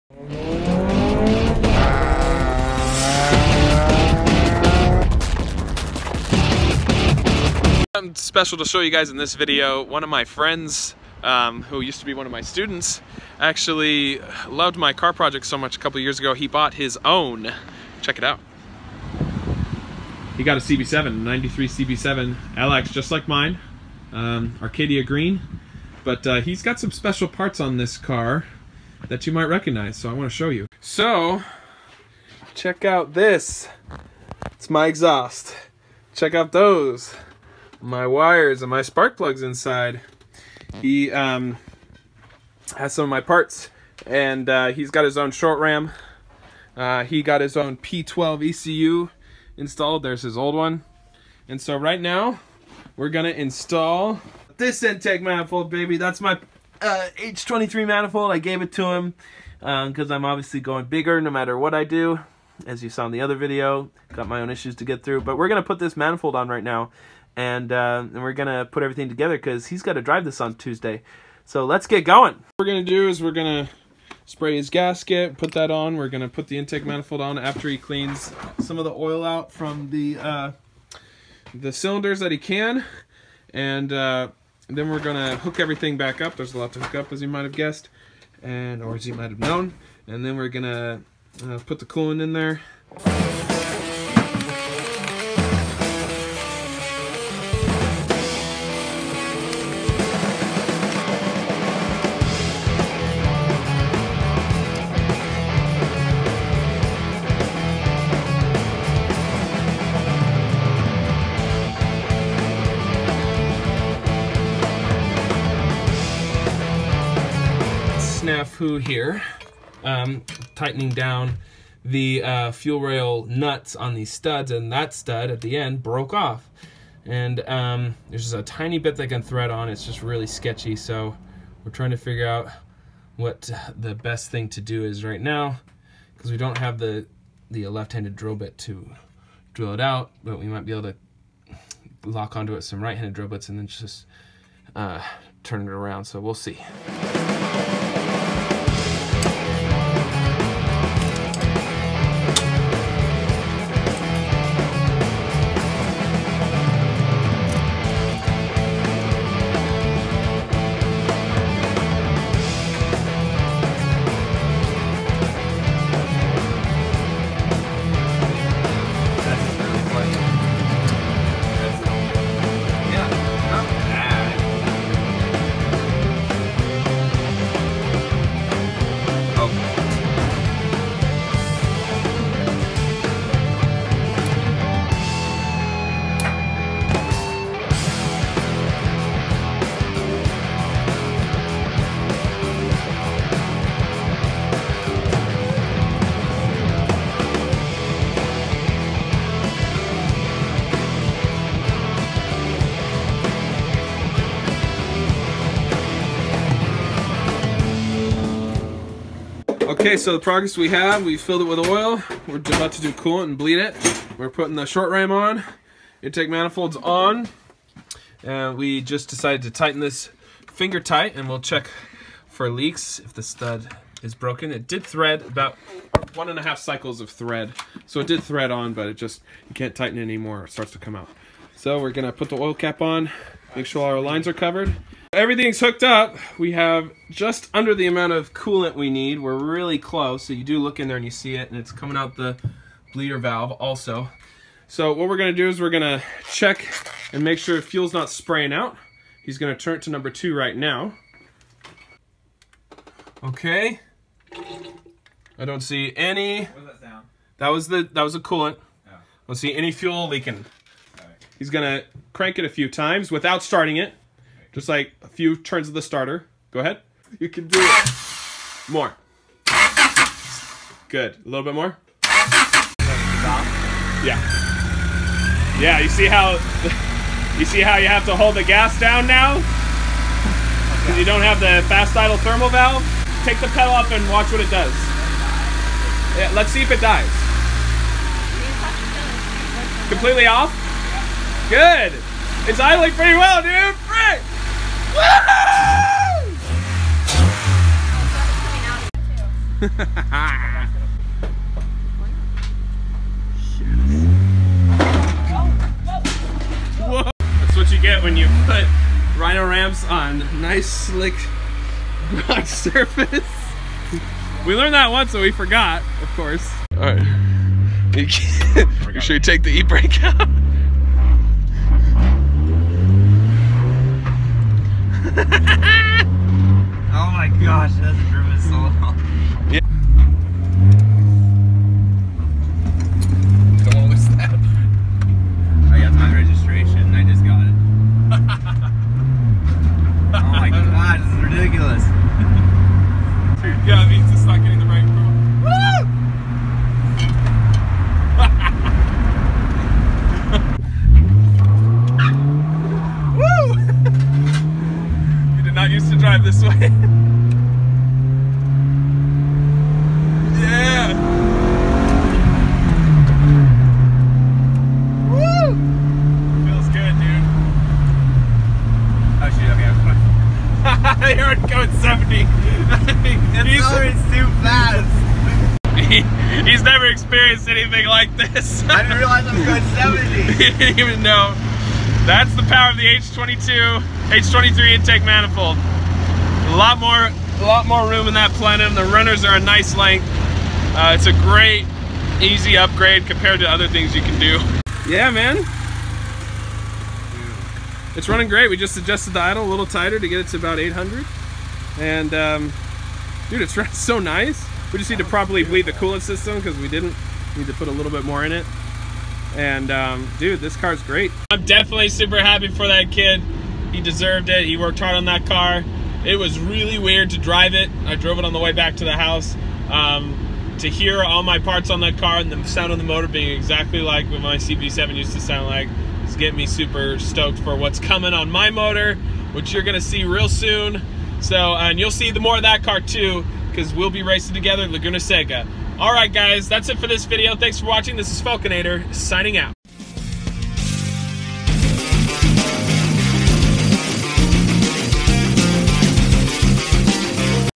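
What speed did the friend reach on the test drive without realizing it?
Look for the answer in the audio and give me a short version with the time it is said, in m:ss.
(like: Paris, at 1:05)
70, at 6:20.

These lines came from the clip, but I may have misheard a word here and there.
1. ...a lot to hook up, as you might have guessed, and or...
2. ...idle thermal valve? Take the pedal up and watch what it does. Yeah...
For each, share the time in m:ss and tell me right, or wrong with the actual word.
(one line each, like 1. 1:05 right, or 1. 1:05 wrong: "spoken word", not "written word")
1. 1:26 right
2. 4:41 right.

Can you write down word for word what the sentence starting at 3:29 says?
Okay, so the progress we have, we filled it with oil.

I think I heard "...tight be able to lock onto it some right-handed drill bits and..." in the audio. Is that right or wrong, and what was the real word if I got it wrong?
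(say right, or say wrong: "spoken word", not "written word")
wrong: "might", not "tight".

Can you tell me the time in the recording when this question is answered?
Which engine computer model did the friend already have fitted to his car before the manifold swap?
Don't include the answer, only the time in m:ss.
0:47.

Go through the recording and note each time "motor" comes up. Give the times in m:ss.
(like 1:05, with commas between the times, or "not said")
7:02, 7:08.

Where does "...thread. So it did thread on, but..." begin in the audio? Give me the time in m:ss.
3:47.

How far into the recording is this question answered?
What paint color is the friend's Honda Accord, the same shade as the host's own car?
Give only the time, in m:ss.
0:24.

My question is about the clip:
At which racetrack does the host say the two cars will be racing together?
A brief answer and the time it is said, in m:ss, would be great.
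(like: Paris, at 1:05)
Laguna Seca, at 7:14.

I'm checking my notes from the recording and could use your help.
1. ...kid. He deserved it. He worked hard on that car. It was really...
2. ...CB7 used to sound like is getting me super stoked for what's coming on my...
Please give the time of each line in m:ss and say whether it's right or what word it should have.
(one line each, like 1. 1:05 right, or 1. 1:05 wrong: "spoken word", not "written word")
1. 6:52 right
2. 7:04 right.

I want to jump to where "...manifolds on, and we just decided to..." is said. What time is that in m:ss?
3:36.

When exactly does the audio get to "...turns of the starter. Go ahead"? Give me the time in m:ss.
4:25.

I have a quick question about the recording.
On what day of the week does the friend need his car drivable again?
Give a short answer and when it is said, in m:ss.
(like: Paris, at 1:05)
Tuesday, at 1:10.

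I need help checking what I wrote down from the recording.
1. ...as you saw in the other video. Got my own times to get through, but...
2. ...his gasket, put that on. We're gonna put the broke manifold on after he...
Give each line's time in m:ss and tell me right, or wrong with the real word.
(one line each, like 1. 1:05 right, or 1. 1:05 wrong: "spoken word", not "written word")
1. 1:02 wrong: "issues", not "times"
2. 1:14 wrong: "intake", not "broke".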